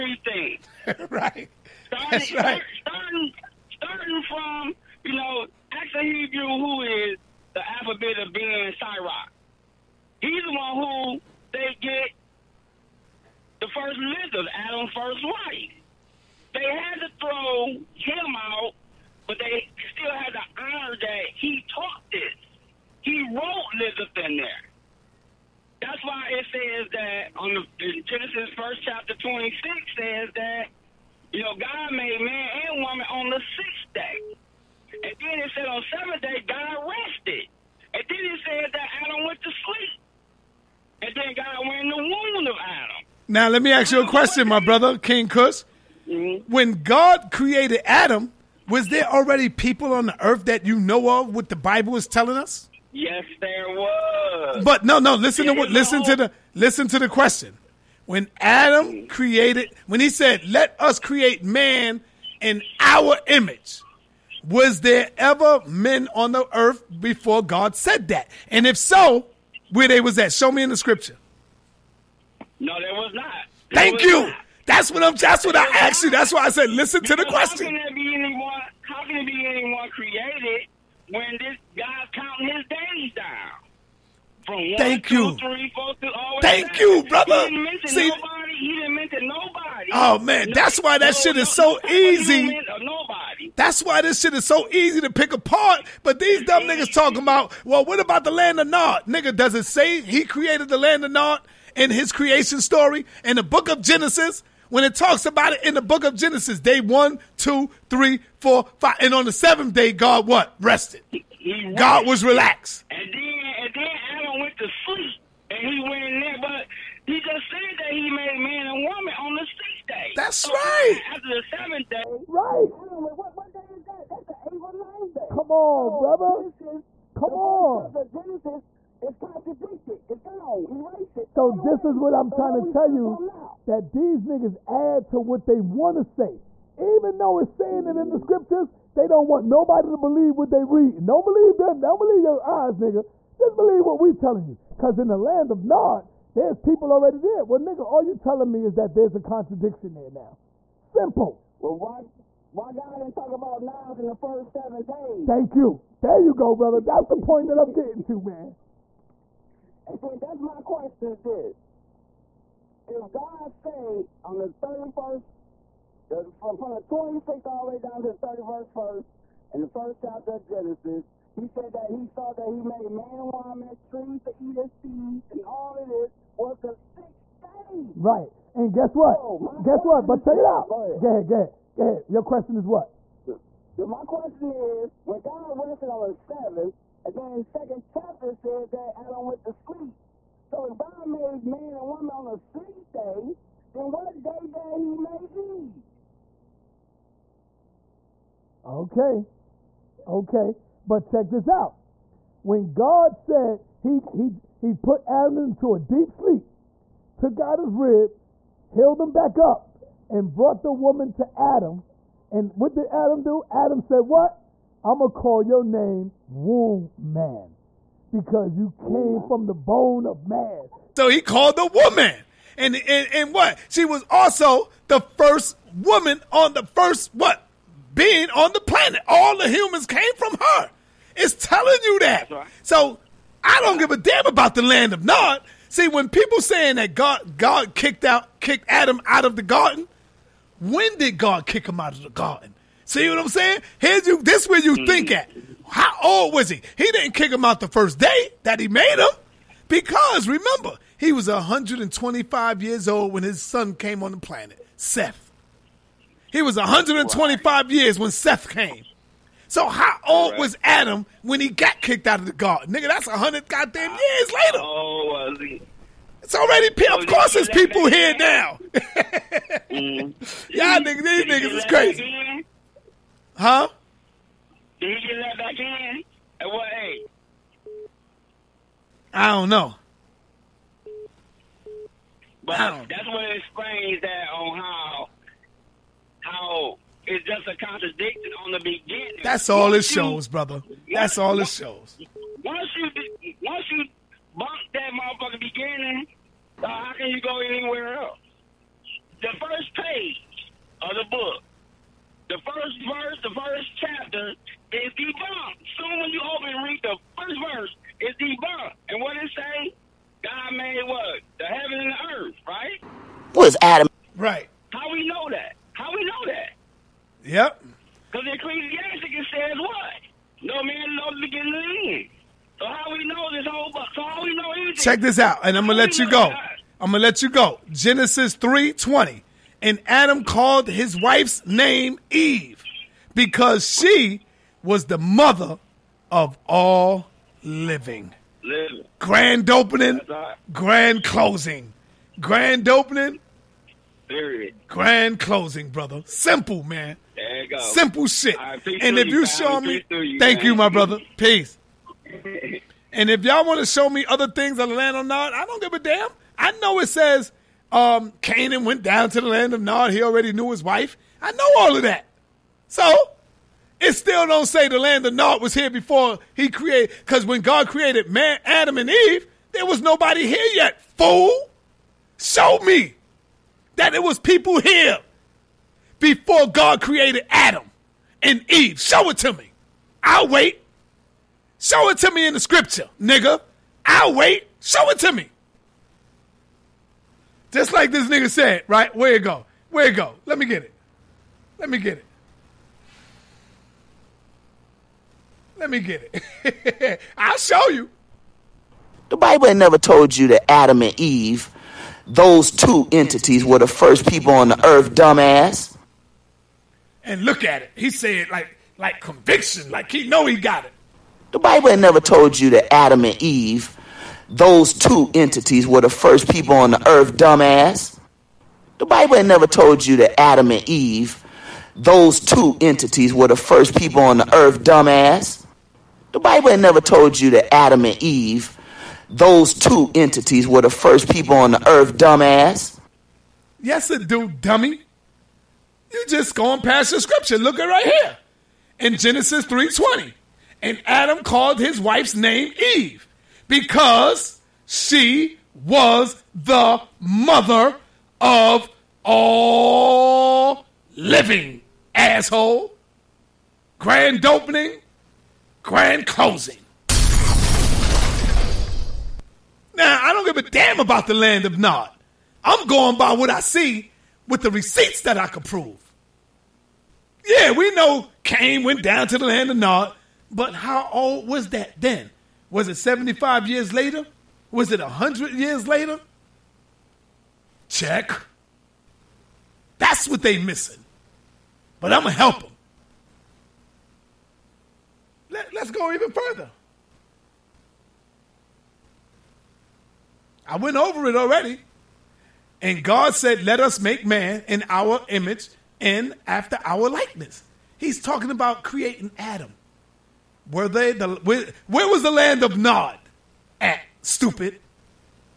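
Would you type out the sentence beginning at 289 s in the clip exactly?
That's all once it shows, you, brother.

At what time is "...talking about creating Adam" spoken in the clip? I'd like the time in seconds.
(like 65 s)
498 s.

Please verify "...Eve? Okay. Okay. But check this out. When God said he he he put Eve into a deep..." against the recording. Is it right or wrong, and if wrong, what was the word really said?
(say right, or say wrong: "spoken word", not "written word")
wrong: "Adam", not "Eve".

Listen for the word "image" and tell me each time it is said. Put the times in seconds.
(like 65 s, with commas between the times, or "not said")
63 s, 495 s.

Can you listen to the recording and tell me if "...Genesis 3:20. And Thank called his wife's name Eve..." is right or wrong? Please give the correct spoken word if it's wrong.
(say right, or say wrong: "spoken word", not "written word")
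wrong: "Adam", not "Thank".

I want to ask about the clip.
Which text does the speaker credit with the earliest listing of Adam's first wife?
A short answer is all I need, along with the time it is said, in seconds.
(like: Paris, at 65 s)
Alphabet of Ben Sirach, at 7 s.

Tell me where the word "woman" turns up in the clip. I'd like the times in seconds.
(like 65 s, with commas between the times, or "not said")
32 s, 118 s, 173 s, 191 s, 210 s, 221 s, 225 s.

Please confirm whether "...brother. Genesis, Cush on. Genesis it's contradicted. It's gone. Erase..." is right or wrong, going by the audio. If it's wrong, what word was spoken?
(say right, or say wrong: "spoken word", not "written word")
wrong: "Come", not "Cush".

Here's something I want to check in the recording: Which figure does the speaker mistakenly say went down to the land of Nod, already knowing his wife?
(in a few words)
Canaan.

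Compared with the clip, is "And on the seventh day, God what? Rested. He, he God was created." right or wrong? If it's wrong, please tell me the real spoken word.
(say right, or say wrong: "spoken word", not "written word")
wrong: "relaxed", not "created".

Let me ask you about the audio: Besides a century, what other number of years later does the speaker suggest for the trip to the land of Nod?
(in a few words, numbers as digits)
75.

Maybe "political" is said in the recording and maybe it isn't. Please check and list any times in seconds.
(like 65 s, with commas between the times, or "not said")
not said.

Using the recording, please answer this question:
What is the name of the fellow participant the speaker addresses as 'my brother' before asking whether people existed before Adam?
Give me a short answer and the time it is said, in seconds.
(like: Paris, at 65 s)
King Cush, at 44 s.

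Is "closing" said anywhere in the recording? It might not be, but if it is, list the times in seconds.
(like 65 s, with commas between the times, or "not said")
341 s, 345 s, 456 s.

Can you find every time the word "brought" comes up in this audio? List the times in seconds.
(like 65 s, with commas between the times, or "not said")
210 s.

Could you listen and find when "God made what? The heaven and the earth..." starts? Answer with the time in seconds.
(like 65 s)
310 s.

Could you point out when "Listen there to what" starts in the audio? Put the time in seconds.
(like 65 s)
55 s.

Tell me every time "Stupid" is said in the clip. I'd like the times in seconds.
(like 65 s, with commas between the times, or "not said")
504 s.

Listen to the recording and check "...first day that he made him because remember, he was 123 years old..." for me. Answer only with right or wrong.
wrong.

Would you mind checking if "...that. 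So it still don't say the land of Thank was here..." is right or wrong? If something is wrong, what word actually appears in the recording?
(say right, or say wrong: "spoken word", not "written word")
wrong: "Nod", not "Thank".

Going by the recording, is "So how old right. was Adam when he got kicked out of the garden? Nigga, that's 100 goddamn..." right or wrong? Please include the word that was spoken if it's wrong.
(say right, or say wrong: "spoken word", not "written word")
right.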